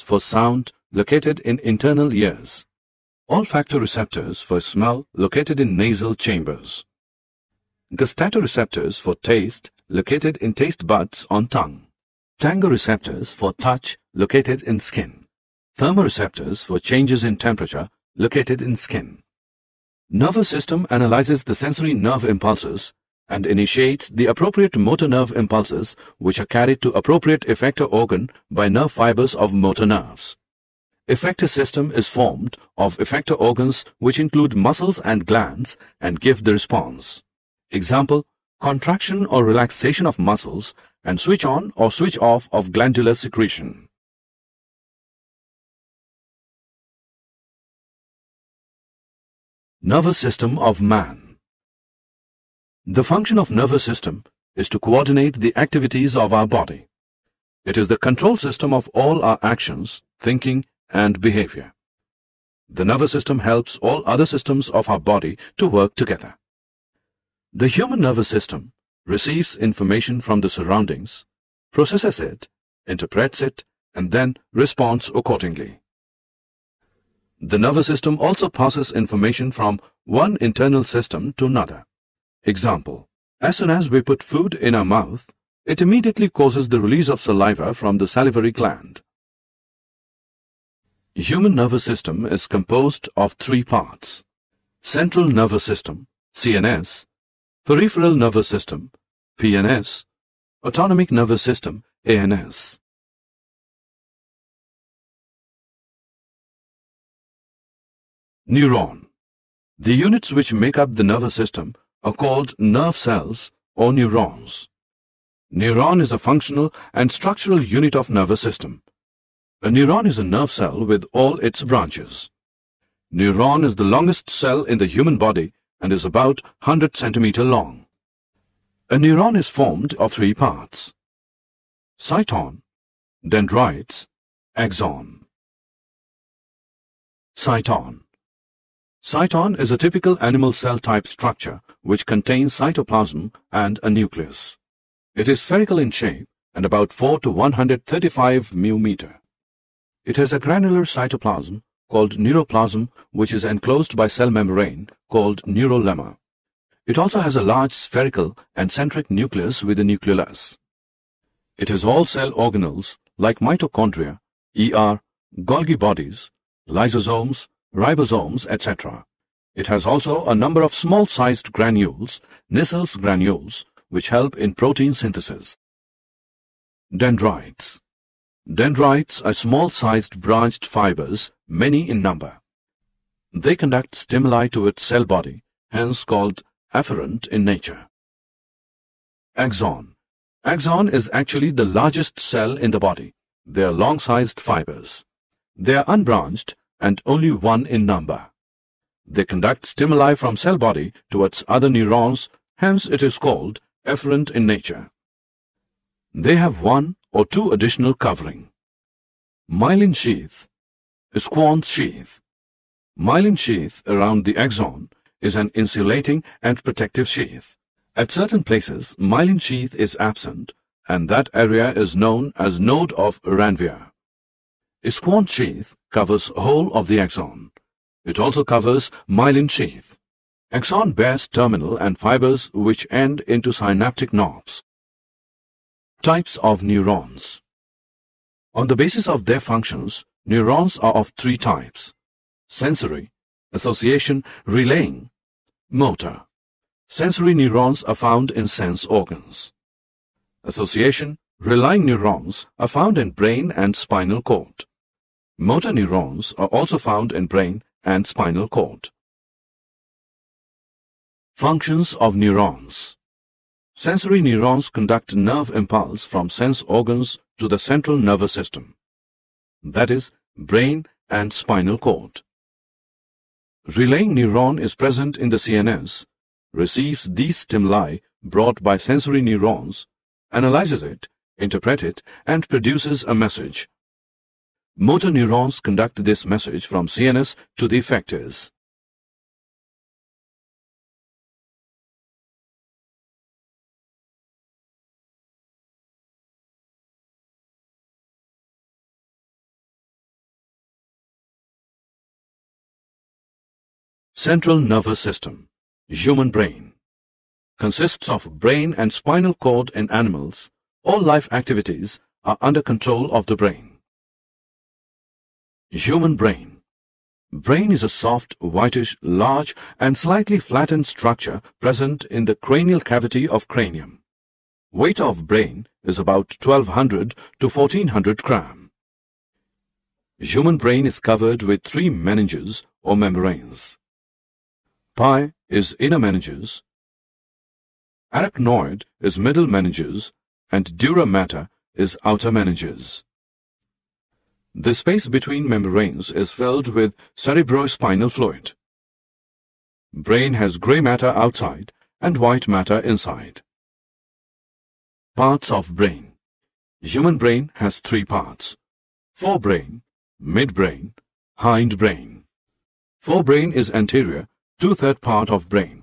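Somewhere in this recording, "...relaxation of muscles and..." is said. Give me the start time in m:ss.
0:39.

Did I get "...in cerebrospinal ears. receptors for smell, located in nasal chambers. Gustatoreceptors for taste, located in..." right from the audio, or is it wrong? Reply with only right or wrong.
wrong.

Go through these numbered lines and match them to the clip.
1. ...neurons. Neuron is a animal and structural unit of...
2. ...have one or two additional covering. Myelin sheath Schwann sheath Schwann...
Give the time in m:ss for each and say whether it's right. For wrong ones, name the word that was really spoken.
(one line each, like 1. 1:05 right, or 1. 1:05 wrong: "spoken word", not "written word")
1. 1:53 wrong: "functional", not "animal"
2. 3:26 wrong: "Myelin", not "Schwann".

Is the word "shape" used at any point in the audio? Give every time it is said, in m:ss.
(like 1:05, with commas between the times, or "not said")
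2:25.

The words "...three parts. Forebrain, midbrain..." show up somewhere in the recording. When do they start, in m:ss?
5:57.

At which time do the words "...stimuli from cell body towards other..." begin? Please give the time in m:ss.
3:19.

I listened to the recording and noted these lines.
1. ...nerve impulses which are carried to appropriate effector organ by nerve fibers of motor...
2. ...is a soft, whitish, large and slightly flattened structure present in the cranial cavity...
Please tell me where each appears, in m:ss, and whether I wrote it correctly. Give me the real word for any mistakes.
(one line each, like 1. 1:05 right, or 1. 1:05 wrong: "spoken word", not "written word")
1. 0:25 right
2. 5:17 right.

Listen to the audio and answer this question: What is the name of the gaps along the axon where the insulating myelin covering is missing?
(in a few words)
node of Ranvier.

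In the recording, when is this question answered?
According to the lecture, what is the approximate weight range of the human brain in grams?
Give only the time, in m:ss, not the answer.
5:26.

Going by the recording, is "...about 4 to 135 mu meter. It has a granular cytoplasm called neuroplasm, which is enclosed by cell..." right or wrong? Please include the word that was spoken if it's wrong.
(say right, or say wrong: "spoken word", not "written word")
right.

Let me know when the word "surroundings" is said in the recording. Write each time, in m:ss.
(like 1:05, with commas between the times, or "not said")
1:10.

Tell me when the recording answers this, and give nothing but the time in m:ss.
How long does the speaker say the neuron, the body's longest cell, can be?
2:06.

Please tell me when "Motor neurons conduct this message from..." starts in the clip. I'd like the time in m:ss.
4:44.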